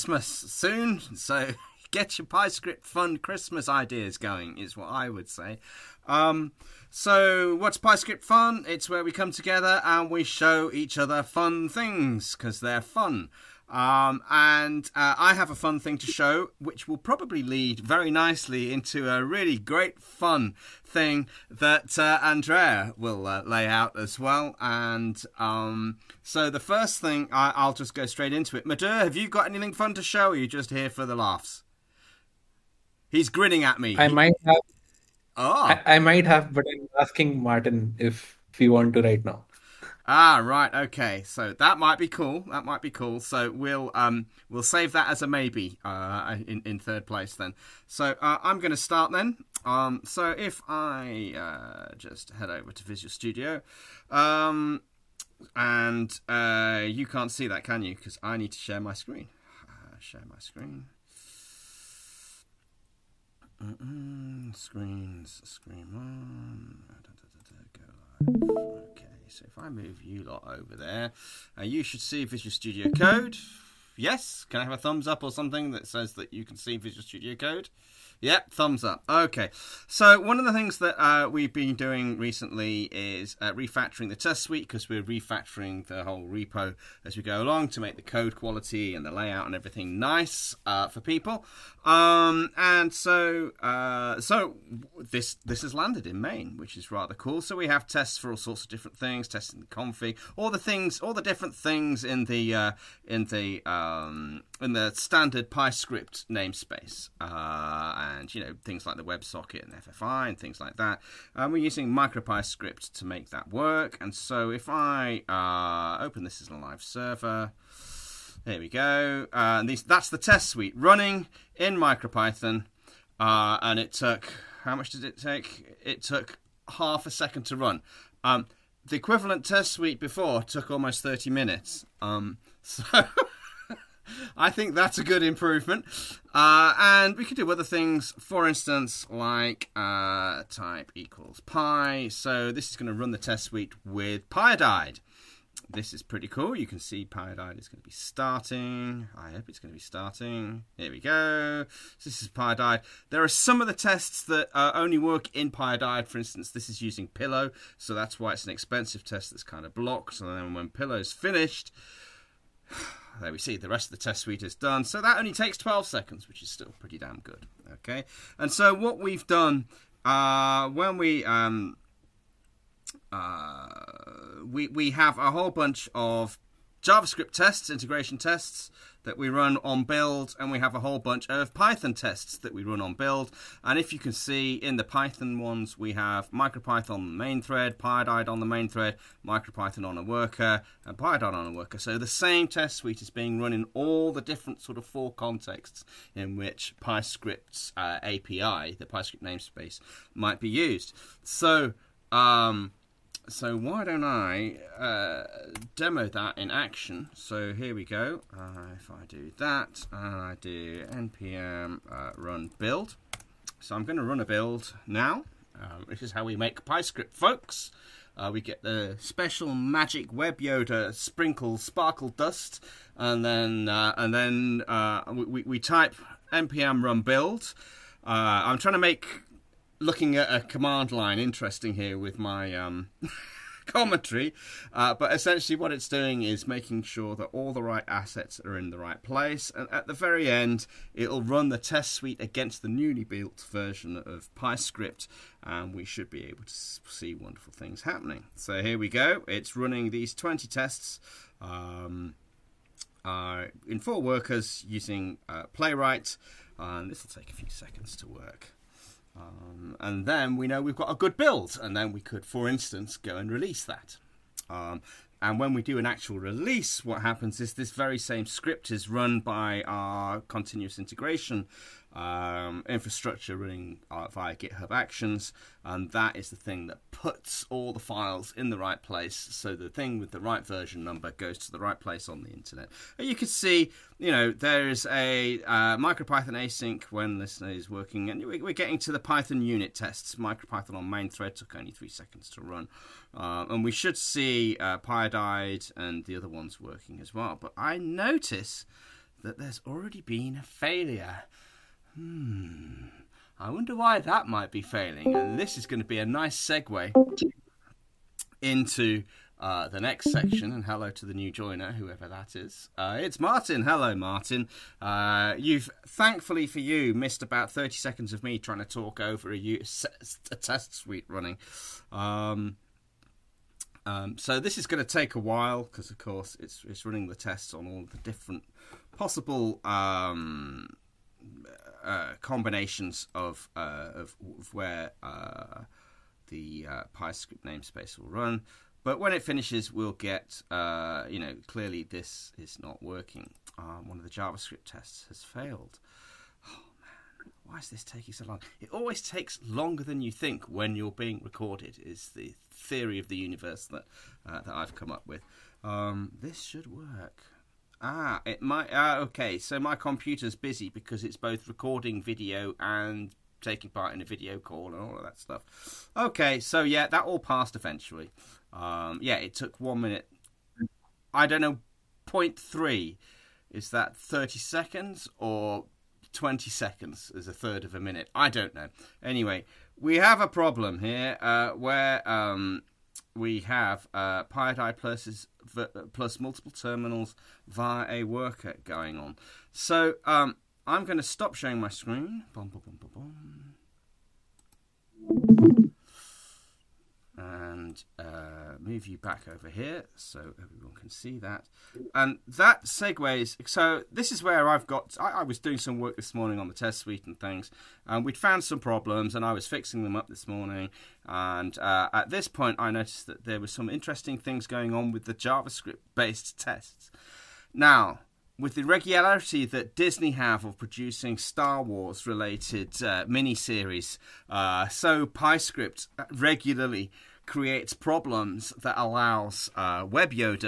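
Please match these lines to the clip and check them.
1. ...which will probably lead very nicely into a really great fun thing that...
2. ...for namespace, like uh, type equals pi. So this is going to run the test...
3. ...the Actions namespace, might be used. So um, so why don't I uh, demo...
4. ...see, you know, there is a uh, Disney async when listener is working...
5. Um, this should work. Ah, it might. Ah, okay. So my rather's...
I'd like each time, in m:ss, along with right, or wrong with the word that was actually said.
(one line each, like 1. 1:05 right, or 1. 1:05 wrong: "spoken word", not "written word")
1. 0:16 right
2. 2:18 wrong: "instance", not "namespace"
3. 3:18 wrong: "PyScript", not "Actions"
4. 4:43 wrong: "MicroPython", not "Disney"
5. 5:55 wrong: "computer", not "rather".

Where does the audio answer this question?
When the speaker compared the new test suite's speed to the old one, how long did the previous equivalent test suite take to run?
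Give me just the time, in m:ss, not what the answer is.
2:10.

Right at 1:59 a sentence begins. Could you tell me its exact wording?
Uh, and these, that's the test suite running in MicroPython, uh, and it took how much did it take?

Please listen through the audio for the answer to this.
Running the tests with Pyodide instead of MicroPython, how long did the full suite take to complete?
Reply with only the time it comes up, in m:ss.
2:45.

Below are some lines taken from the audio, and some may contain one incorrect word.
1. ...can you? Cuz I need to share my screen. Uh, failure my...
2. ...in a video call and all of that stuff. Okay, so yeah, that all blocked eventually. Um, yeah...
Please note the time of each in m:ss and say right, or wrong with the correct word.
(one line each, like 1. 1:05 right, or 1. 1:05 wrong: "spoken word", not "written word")
1. 0:57 wrong: "share", not "failure"
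2. 6:03 wrong: "passed", not "blocked".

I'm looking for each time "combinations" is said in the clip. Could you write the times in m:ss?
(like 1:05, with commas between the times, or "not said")
5:32.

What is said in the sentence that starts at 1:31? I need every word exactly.
Um, and so, uh, so this this has landed in main, which is rather cool.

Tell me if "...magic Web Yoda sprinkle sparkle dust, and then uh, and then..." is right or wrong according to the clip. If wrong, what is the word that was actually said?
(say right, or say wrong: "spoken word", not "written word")
right.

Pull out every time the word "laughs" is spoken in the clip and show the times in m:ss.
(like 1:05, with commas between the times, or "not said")
0:31.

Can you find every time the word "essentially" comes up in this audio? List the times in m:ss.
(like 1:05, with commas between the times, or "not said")
3:55.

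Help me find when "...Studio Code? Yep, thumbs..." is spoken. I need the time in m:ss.
1:17.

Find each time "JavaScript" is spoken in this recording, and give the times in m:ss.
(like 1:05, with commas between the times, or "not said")
2:56, 5:44, 6:55.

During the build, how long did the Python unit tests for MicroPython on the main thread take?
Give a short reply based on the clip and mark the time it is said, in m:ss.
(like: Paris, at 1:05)
3 seconds, at 4:51.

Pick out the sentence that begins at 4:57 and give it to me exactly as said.
But I notice that there's already been a failure.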